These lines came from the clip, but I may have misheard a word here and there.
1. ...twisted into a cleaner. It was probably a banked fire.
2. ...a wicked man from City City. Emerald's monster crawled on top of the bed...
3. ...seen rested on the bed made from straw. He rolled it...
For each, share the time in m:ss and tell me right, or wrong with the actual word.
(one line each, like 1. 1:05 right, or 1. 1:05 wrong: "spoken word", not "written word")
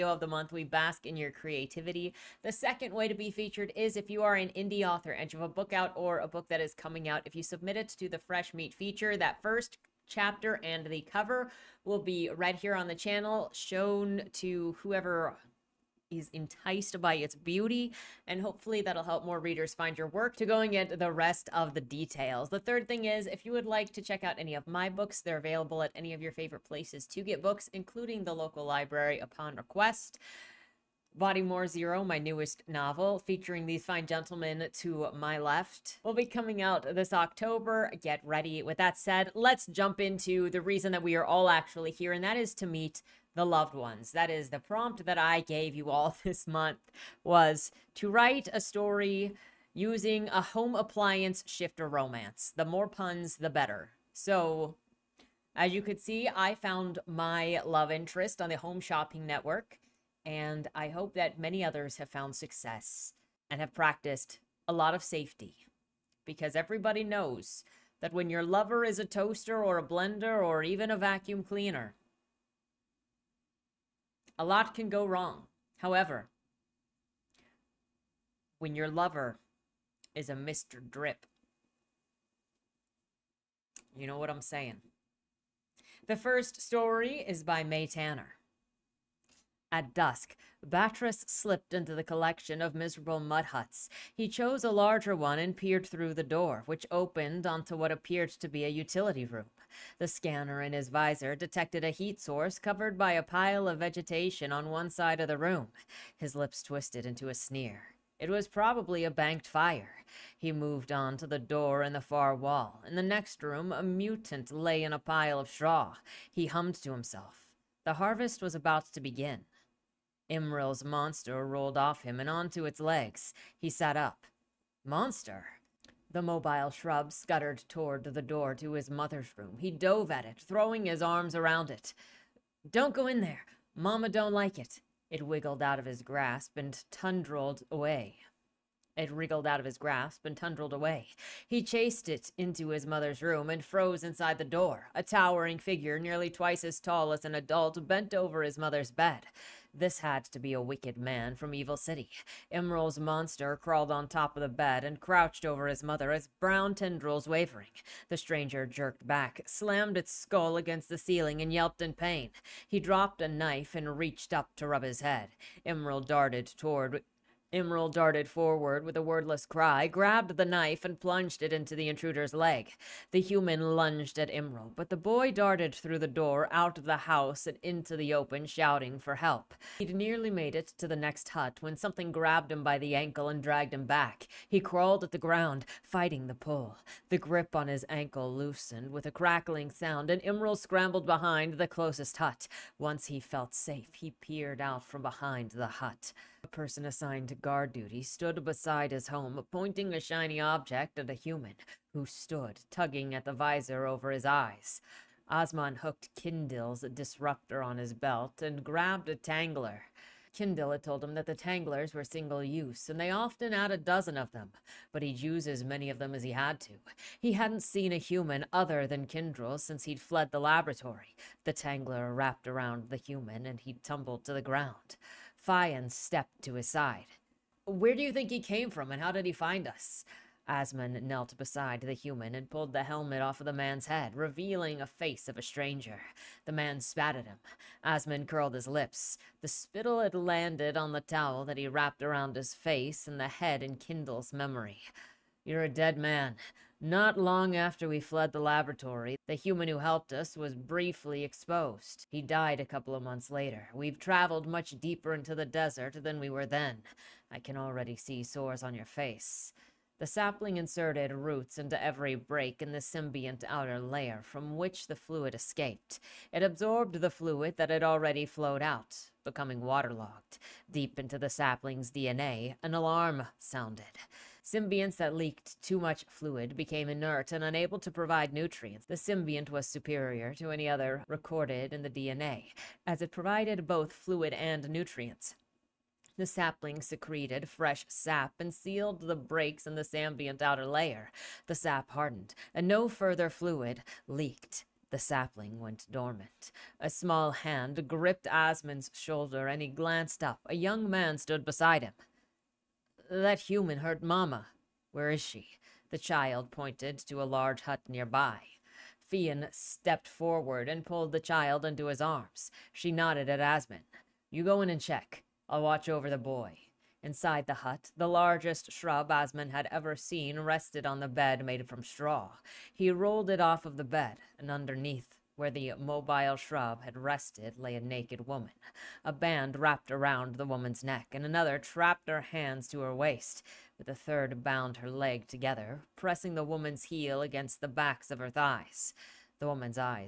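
1. 1:46 wrong: "sneer", not "cleaner"
2. 2:30 wrong: "Evil", not "City"
3. 5:19 right.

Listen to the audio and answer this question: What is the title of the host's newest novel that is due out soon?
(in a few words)
Body More Zero.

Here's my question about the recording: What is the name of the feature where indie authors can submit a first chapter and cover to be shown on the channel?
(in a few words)
Fresh Meat.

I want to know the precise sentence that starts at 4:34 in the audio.
Symbionts that leaked too much fluid became inert and unable to provide nutrients.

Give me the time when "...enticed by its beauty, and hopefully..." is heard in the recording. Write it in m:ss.
0:16.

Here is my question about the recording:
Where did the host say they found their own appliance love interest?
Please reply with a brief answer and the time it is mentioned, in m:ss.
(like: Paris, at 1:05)
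Home Shopping Network, at 0:58.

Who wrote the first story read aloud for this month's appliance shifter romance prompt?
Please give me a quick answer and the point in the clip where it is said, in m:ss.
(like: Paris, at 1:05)
Mae Tanner, at 1:27.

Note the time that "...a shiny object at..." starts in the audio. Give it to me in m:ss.
3:19.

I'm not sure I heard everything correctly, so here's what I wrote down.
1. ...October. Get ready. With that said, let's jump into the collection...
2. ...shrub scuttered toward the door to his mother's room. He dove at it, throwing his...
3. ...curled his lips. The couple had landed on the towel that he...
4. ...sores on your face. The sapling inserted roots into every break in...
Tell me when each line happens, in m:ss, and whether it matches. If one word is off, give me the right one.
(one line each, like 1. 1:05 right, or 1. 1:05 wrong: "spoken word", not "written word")
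1. 0:37 wrong: "reason", not "collection"
2. 2:06 right
3. 3:58 wrong: "spittle", not "couple"
4. 4:18 right.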